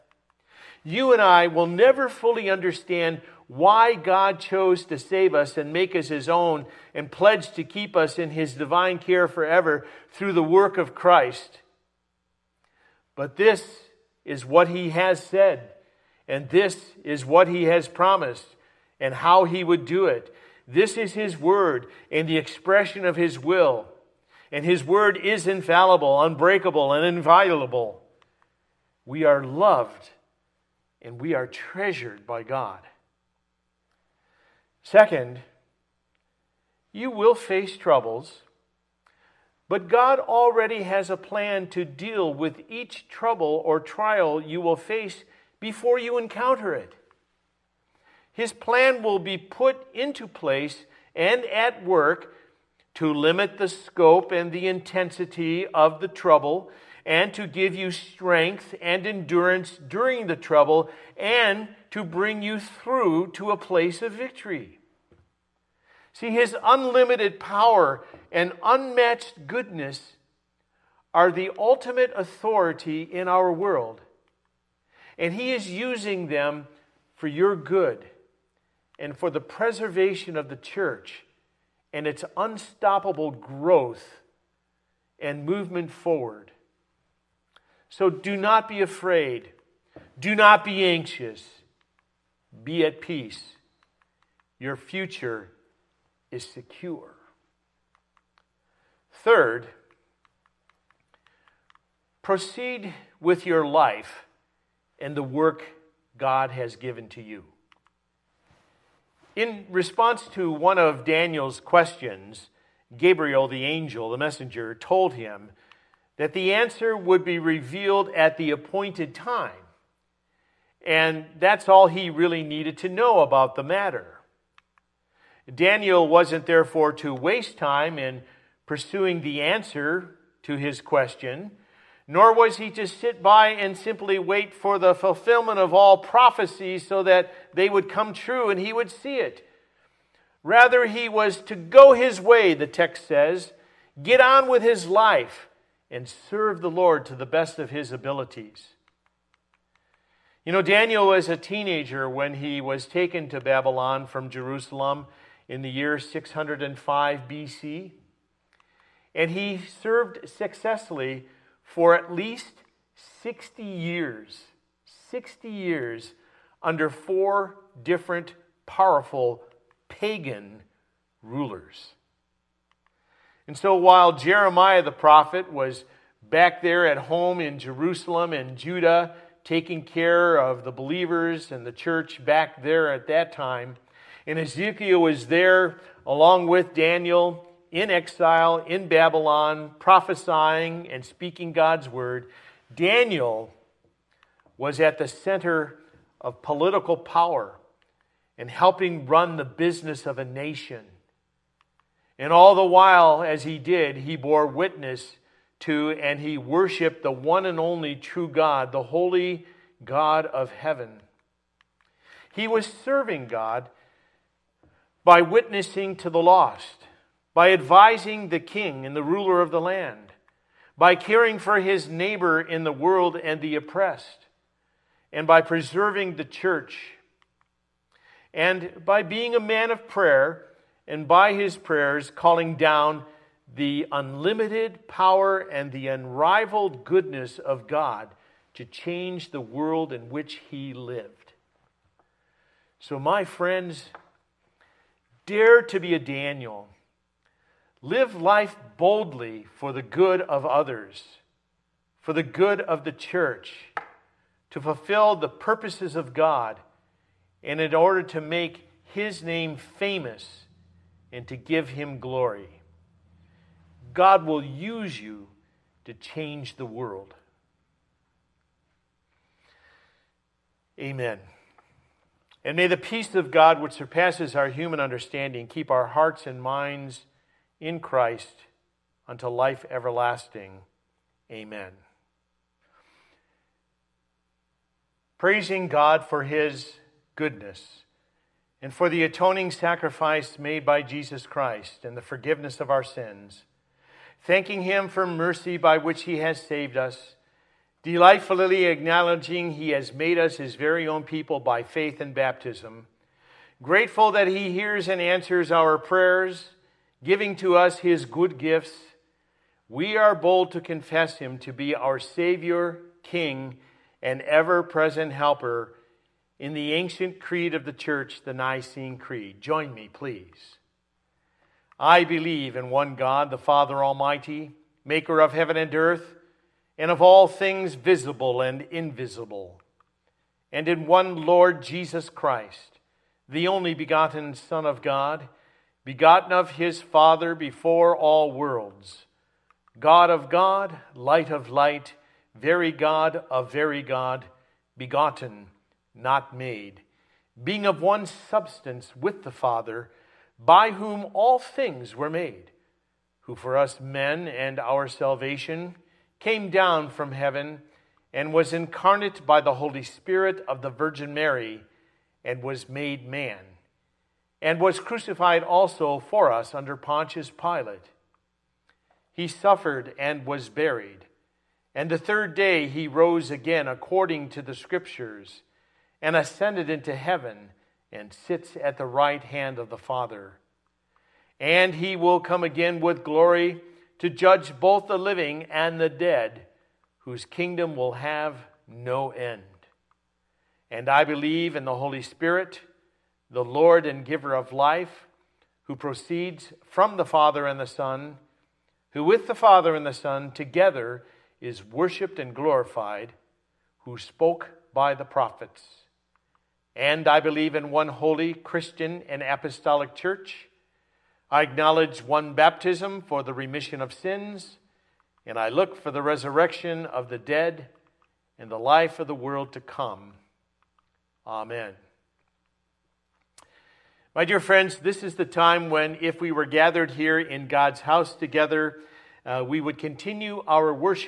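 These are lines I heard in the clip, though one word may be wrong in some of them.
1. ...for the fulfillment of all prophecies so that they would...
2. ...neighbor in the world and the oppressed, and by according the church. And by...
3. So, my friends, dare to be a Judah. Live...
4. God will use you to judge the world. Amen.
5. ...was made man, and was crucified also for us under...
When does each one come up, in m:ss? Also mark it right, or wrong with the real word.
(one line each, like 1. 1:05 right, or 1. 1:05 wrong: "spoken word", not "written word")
1. 2:14 right
2. 3:41 wrong: "preserving", not "according"
3. 4:02 wrong: "Daniel", not "Judah"
4. 4:23 wrong: "change", not "judge"
5. 6:02 right.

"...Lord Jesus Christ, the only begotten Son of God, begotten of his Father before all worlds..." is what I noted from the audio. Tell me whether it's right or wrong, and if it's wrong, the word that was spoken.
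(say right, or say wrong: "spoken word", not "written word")
right.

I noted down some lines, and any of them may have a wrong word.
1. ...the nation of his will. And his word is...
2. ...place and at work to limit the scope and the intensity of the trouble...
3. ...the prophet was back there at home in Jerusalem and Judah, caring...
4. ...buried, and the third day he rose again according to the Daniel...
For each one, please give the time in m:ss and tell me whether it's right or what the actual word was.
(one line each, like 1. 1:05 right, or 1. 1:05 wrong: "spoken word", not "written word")
1. 0:22 wrong: "expression", not "nation"
2. 0:50 right
3. 2:54 wrong: "taking", not "caring"
4. 6:10 wrong: "Scriptures", not "Daniel".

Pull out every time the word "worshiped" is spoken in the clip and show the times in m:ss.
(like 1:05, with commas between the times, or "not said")
3:26, 6:41.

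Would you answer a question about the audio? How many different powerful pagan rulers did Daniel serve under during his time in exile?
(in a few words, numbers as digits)
4.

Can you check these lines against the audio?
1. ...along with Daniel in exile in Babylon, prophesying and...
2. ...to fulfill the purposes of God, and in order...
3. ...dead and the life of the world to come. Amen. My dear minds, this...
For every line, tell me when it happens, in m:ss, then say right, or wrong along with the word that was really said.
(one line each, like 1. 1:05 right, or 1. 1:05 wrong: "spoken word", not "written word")
1. 3:06 right
2. 4:14 right
3. 6:57 wrong: "friends", not "minds".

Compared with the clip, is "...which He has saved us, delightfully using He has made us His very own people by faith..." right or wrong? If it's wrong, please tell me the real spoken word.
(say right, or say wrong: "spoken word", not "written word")
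wrong: "acknowledging", not "using".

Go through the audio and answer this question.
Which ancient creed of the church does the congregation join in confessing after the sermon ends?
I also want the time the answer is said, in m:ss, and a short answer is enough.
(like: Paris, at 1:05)
Nicene Creed, at 5:18.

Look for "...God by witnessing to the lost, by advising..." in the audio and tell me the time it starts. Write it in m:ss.
3:33.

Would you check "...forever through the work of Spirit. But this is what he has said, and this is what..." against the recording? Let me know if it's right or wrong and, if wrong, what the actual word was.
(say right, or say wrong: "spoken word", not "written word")
wrong: "Christ", not "Spirit".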